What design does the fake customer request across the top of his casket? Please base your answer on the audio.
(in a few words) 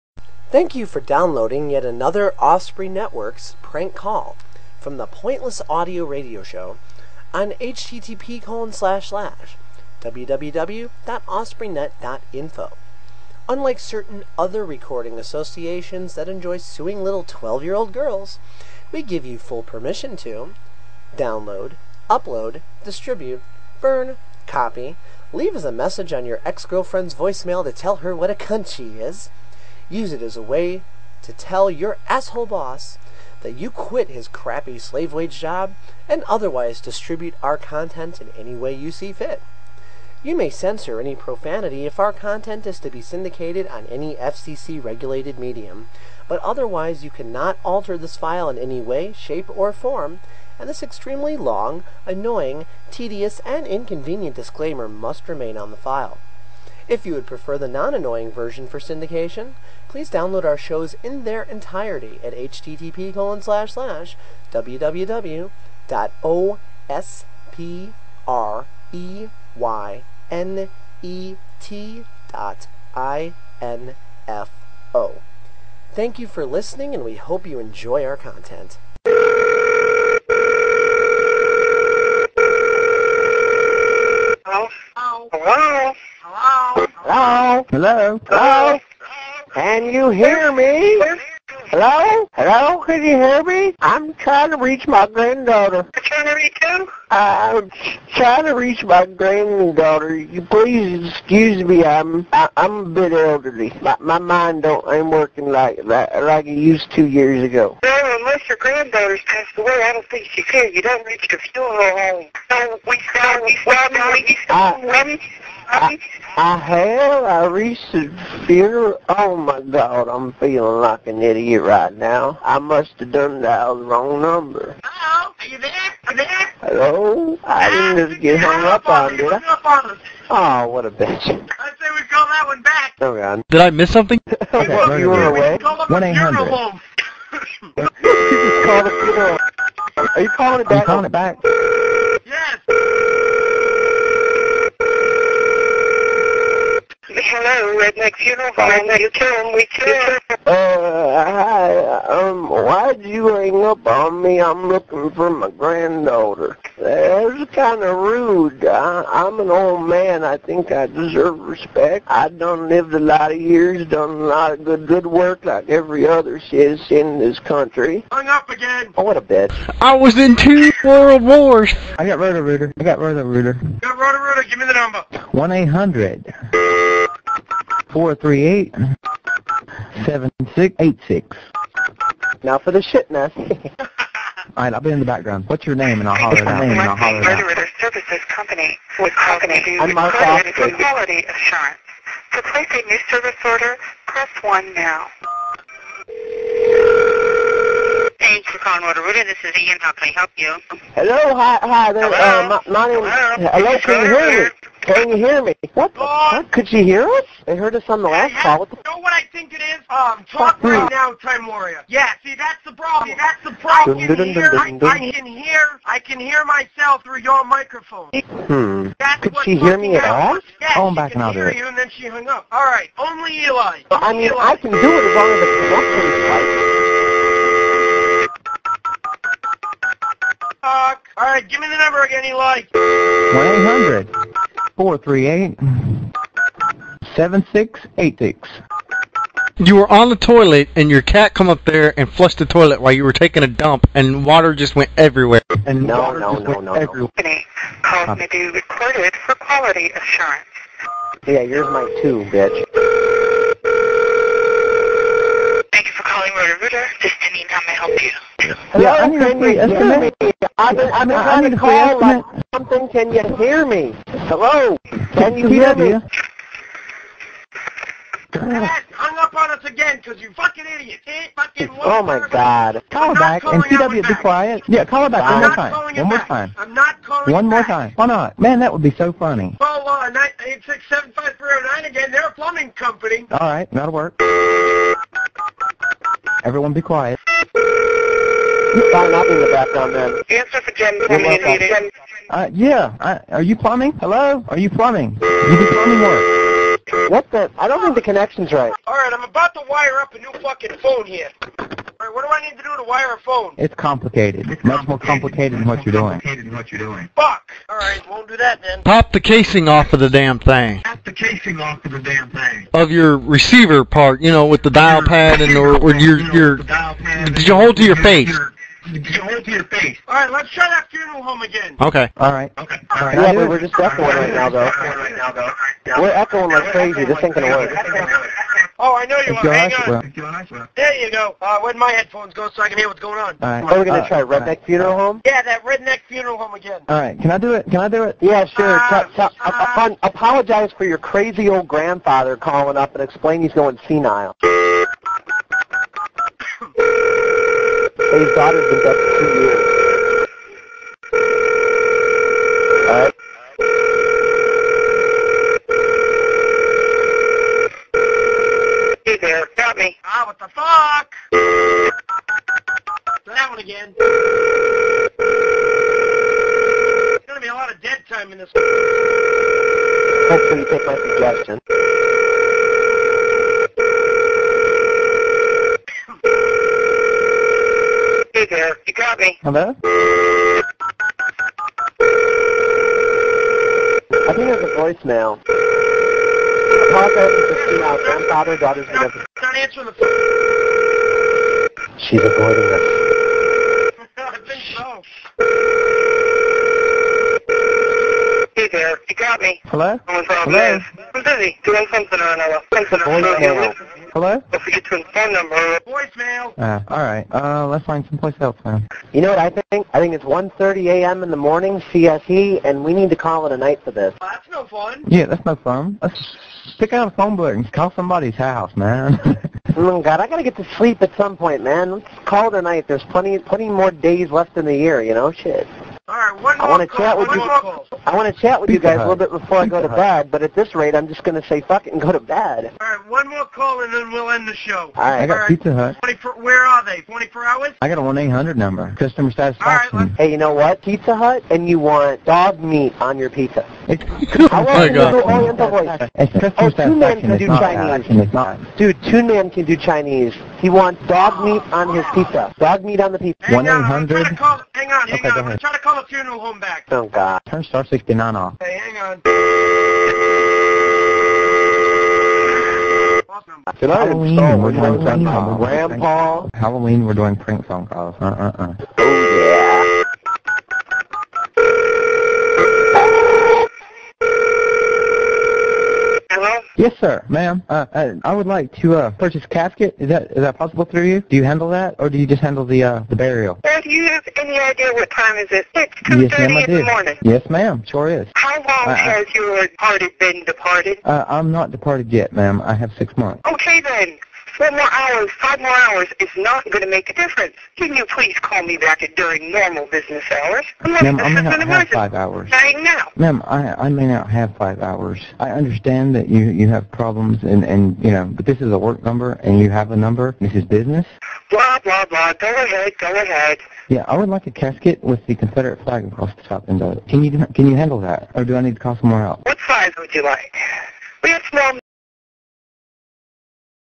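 Confederate flag.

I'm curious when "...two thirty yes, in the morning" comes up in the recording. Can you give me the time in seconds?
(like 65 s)
486 s.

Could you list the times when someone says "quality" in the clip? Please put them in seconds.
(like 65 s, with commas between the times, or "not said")
190 s, 249 s.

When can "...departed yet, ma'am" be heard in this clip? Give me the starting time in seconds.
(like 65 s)
491 s.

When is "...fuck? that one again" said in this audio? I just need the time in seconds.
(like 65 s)
360 s.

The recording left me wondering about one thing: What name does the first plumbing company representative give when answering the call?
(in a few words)
Ian.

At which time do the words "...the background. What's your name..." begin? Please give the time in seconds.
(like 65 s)
184 s.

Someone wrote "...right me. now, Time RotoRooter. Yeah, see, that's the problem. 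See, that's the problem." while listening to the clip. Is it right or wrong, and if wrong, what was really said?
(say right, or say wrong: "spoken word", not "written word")
wrong: "Warrior", not "RotoRooter".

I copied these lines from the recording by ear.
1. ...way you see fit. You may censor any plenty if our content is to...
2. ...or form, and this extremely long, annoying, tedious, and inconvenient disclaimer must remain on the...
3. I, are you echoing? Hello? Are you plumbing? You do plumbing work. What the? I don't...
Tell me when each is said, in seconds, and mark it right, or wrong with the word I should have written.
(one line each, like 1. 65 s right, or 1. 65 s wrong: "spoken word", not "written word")
1. 38 s wrong: "profanity", not "plenty"
2. 49 s right
3. 293 s wrong: "plumbing", not "echoing".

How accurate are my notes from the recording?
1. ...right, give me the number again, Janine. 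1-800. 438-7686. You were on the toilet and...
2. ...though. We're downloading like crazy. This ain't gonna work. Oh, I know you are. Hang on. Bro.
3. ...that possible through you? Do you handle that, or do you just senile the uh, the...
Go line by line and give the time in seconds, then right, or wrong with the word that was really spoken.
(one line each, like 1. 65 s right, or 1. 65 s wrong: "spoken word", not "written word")
1. 231 s wrong: "Eli", not "Janine"
2. 324 s wrong: "echoing", not "downloading"
3. 480 s wrong: "handle", not "senile".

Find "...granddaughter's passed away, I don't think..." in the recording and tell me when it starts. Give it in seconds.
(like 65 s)
108 s.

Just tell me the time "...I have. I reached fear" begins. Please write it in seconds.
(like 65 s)
116 s.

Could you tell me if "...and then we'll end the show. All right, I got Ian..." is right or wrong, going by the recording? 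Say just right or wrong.
wrong.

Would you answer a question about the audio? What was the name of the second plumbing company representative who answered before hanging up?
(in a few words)
Janine.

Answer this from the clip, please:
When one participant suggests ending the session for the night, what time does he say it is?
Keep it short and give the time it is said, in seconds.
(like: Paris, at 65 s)
1:30 a.m., at 410 s.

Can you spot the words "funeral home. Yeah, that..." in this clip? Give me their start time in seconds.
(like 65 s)
334 s.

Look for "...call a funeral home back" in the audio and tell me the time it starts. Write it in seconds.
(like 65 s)
455 s.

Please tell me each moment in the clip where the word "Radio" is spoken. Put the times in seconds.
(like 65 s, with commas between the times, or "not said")
6 s.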